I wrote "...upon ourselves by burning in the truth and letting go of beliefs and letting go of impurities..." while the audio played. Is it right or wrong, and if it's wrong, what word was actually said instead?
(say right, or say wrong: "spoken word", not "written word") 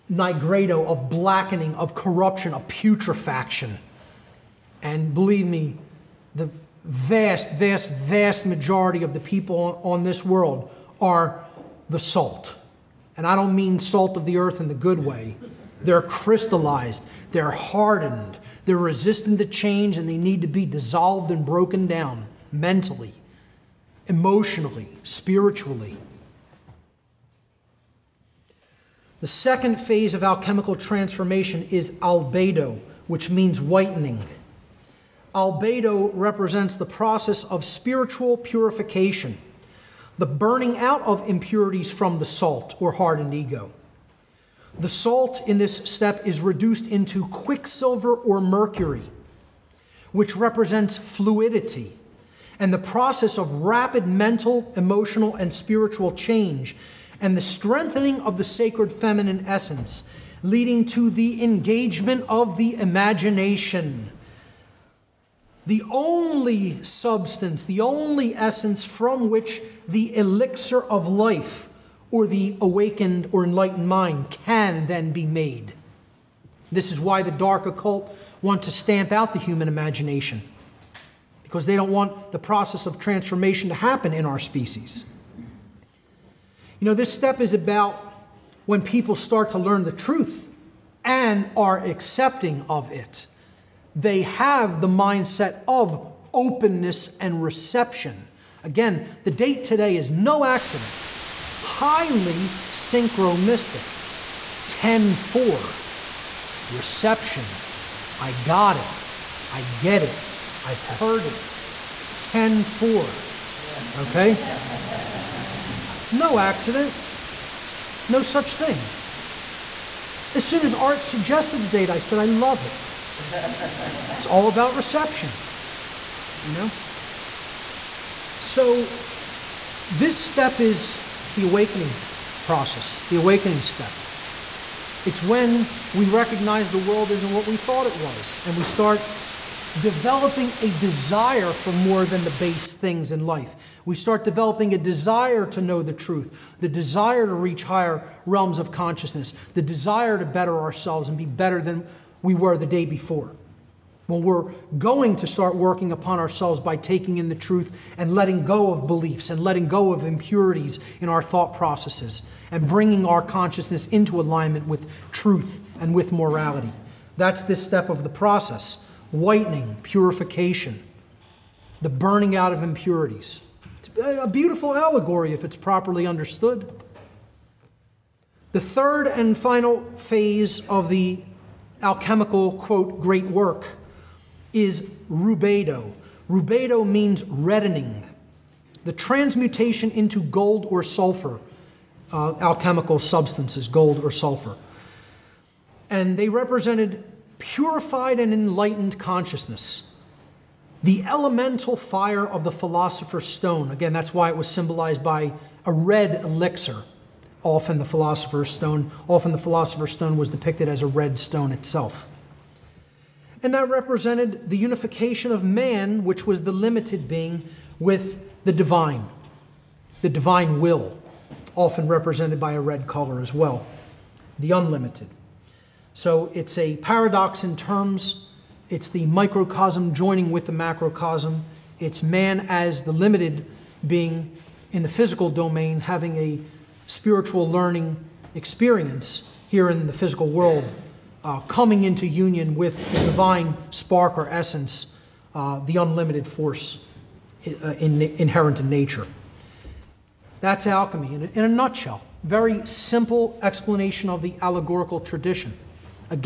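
wrong: "taking", not "burning".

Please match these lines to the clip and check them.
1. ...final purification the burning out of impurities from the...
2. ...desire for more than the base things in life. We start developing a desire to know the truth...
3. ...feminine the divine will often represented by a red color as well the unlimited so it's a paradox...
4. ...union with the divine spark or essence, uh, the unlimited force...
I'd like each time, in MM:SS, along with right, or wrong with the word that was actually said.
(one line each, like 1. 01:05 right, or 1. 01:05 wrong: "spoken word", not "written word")
1. 00:37 wrong: "spiritual", not "final"
2. 02:20 right
3. 03:38 wrong: "divine", not "feminine"
4. 04:02 right.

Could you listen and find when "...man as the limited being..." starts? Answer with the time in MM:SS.
03:52.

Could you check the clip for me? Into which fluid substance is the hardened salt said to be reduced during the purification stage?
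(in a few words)
Quicksilver.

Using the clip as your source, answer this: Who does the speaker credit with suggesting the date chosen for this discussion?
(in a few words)
Art.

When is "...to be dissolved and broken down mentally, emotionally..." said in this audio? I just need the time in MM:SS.
00:20.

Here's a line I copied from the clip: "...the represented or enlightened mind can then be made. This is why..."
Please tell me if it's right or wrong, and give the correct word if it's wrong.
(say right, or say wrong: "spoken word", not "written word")
wrong: "awakened", not "represented".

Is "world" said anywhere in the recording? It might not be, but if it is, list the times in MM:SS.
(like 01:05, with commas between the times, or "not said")
00:10, 02:16, 04:00.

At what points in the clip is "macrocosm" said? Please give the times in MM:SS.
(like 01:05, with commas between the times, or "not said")
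03:50.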